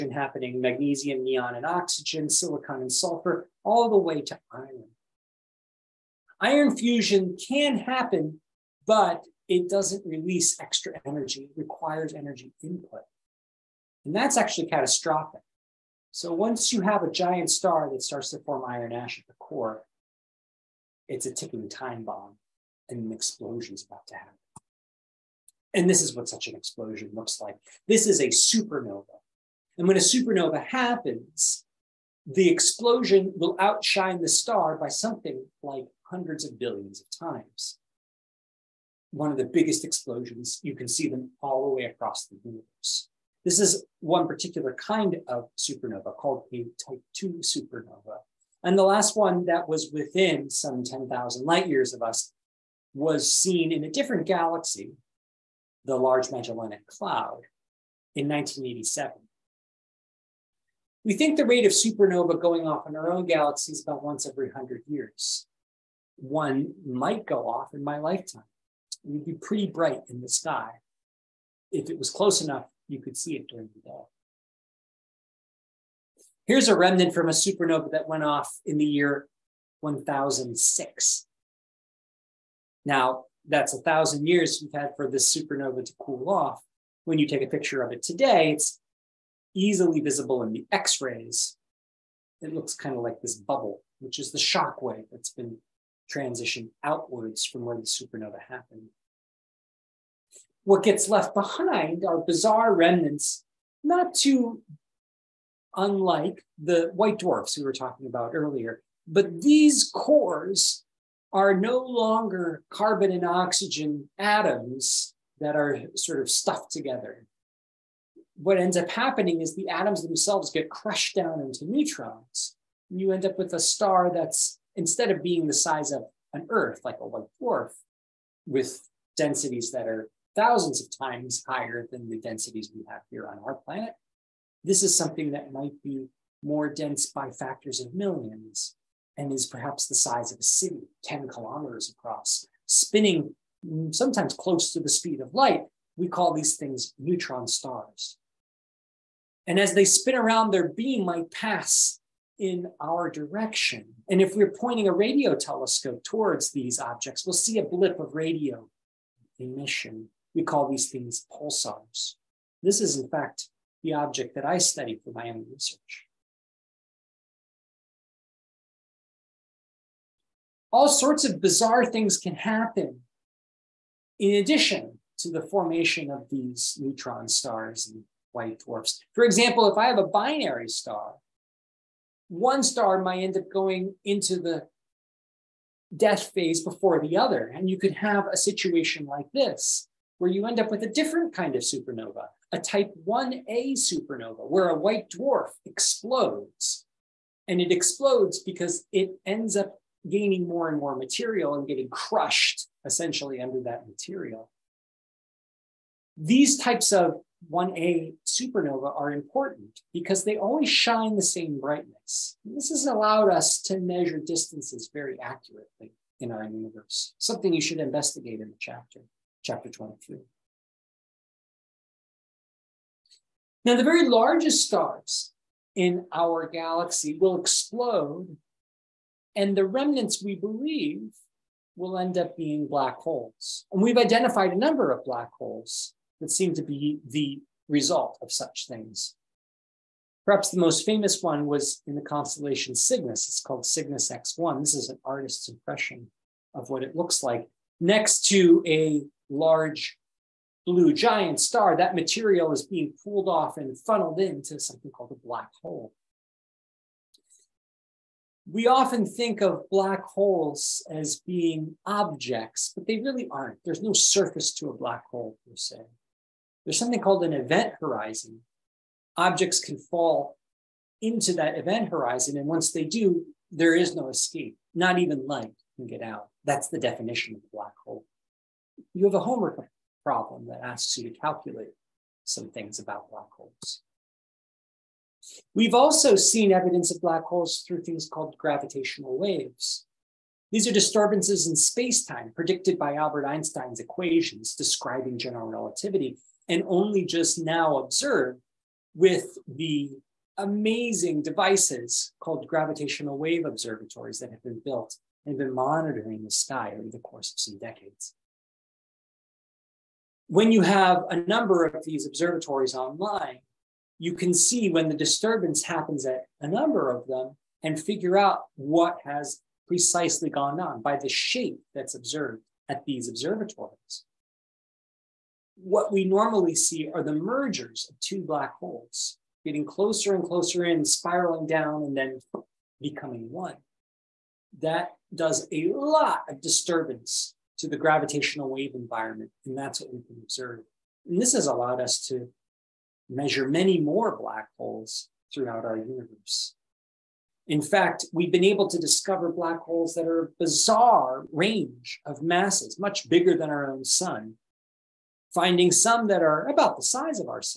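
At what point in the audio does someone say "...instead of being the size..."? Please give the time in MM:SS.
02:04.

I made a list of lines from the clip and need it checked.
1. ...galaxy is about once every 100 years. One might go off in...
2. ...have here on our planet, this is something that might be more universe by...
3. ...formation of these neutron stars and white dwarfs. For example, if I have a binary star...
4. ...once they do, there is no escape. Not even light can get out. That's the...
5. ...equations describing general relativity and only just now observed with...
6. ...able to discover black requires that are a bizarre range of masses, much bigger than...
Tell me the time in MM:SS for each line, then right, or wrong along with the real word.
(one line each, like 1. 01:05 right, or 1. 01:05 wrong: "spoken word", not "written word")
1. 01:03 right
2. 02:12 wrong: "dense", not "universe"
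3. 02:55 right
4. 04:32 right
5. 04:53 right
6. 05:48 wrong: "holes", not "requires".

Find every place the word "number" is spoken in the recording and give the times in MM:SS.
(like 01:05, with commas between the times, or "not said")
03:54, 05:11, 05:16.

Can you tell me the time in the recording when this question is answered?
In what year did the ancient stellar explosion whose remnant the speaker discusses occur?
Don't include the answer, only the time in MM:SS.
01:19.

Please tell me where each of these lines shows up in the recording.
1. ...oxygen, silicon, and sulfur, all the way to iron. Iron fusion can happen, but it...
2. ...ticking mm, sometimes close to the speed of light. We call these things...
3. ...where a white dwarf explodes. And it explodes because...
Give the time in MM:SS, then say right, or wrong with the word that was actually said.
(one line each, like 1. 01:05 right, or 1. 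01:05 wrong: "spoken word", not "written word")
1. 00:01 right
2. 02:22 wrong: "spinning", not "ticking"
3. 03:14 right.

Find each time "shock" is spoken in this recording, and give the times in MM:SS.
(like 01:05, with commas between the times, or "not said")
01:34.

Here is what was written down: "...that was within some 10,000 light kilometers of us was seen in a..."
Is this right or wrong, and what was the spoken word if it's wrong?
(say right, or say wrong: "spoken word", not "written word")
wrong: "years", not "kilometers".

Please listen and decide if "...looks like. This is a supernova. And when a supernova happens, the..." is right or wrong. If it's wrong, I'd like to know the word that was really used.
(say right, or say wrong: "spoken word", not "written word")
right.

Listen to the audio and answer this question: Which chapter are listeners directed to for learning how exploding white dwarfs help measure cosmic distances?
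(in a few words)
23.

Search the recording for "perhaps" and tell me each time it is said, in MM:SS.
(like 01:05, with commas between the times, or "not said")
02:19, 04:00.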